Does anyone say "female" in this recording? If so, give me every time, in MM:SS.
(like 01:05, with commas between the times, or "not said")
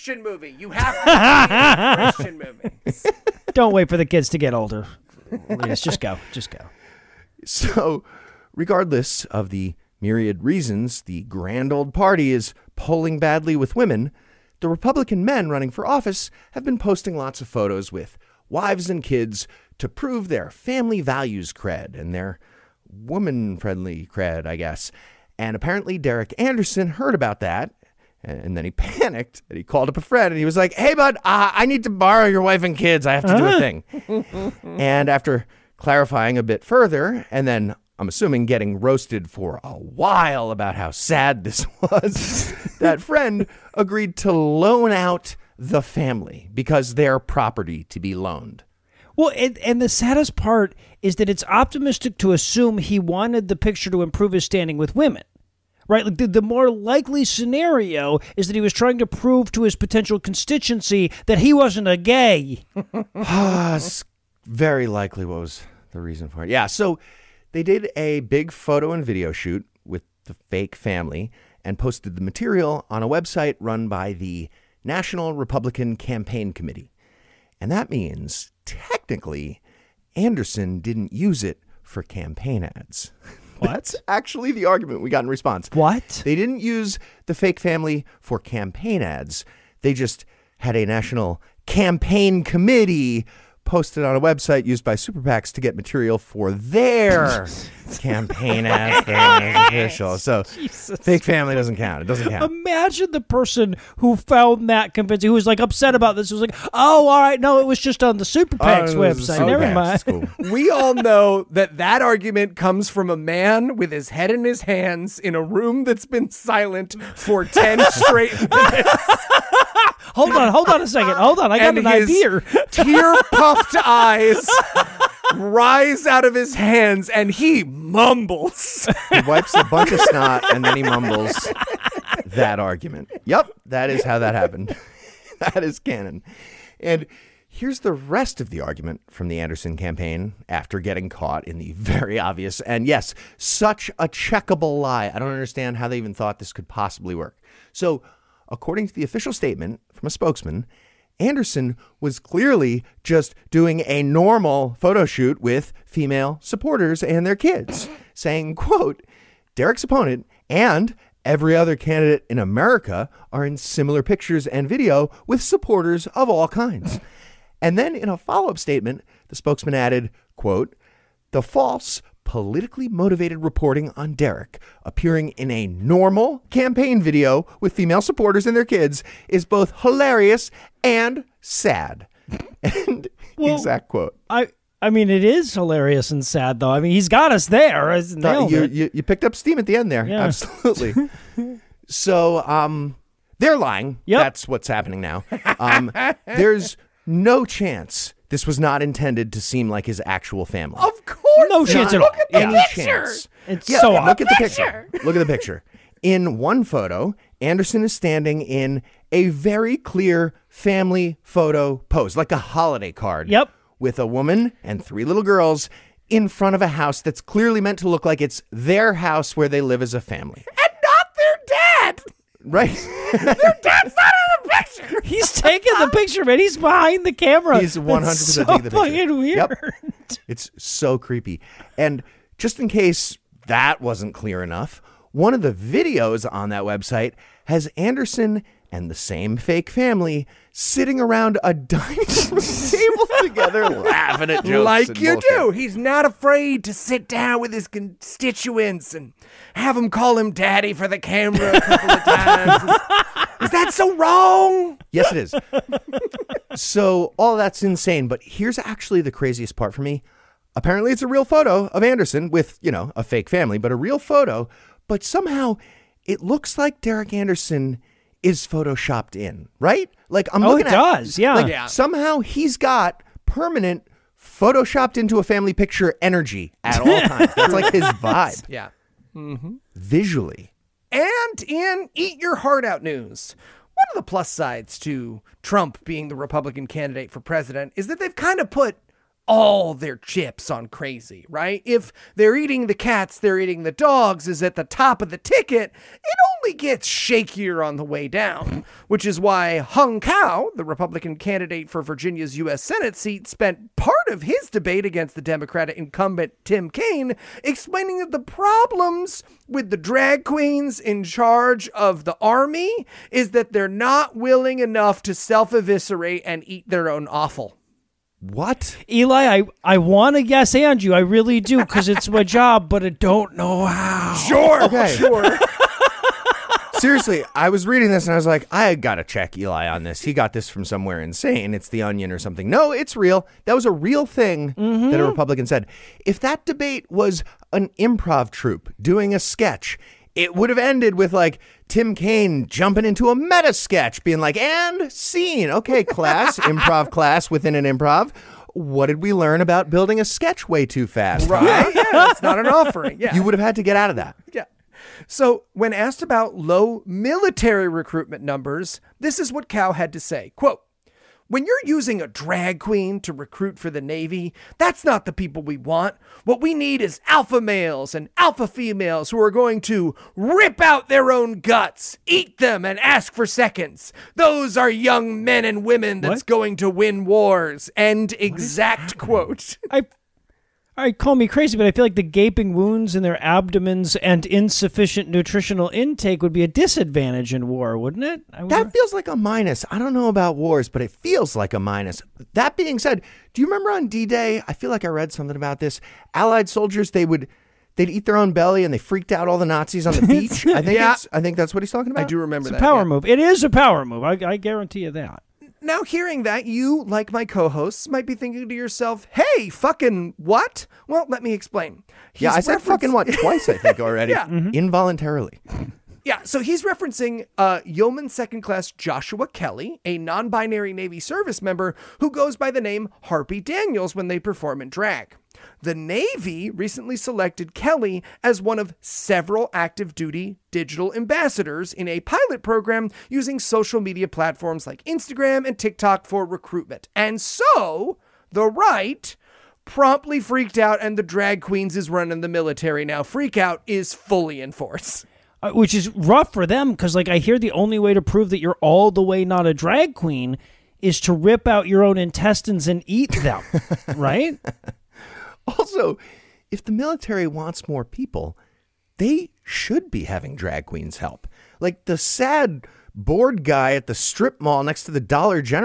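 02:35, 02:57, 06:08.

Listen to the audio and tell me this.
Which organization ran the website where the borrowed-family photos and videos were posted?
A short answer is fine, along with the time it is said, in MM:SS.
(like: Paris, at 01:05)
National Republican Campaign Committee, at 01:14.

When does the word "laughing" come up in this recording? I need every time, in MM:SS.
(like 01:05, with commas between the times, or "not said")
04:03.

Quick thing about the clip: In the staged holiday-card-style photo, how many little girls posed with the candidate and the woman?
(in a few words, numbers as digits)
3.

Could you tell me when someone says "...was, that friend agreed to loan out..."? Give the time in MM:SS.
00:41.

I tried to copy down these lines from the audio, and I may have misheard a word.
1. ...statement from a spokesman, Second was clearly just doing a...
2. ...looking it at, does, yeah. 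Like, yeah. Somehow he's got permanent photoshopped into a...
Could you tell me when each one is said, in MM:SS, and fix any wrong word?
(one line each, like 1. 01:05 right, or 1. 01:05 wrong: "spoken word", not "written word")
1. 02:29 wrong: "Anderson", not "Second"
2. 04:30 right.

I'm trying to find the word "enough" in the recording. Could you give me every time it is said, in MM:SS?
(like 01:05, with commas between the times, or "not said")
03:54, 05:14.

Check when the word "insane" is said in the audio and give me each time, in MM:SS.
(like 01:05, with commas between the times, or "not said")
04:17, 05:30.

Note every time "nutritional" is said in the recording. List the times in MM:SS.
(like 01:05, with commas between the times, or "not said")
06:25.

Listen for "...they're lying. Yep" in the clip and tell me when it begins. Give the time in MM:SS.
03:13.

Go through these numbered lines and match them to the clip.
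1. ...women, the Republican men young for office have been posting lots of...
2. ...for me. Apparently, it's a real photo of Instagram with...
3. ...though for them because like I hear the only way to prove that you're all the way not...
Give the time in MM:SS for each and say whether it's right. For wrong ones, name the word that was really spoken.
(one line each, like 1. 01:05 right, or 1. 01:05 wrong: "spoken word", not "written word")
1. 00:13 wrong: "running", not "young"
2. 04:19 wrong: "Anderson", not "Instagram"
3. 07:25 wrong: "rough", not "though".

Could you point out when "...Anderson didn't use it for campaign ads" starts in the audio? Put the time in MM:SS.
01:20.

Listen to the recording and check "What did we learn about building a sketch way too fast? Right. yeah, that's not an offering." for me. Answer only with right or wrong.
right.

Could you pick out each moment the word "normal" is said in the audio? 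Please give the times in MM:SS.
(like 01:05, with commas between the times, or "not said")
02:34, 02:55.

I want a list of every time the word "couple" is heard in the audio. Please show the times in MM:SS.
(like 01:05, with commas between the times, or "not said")
04:11.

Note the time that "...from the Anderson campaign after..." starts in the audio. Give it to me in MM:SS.
02:19.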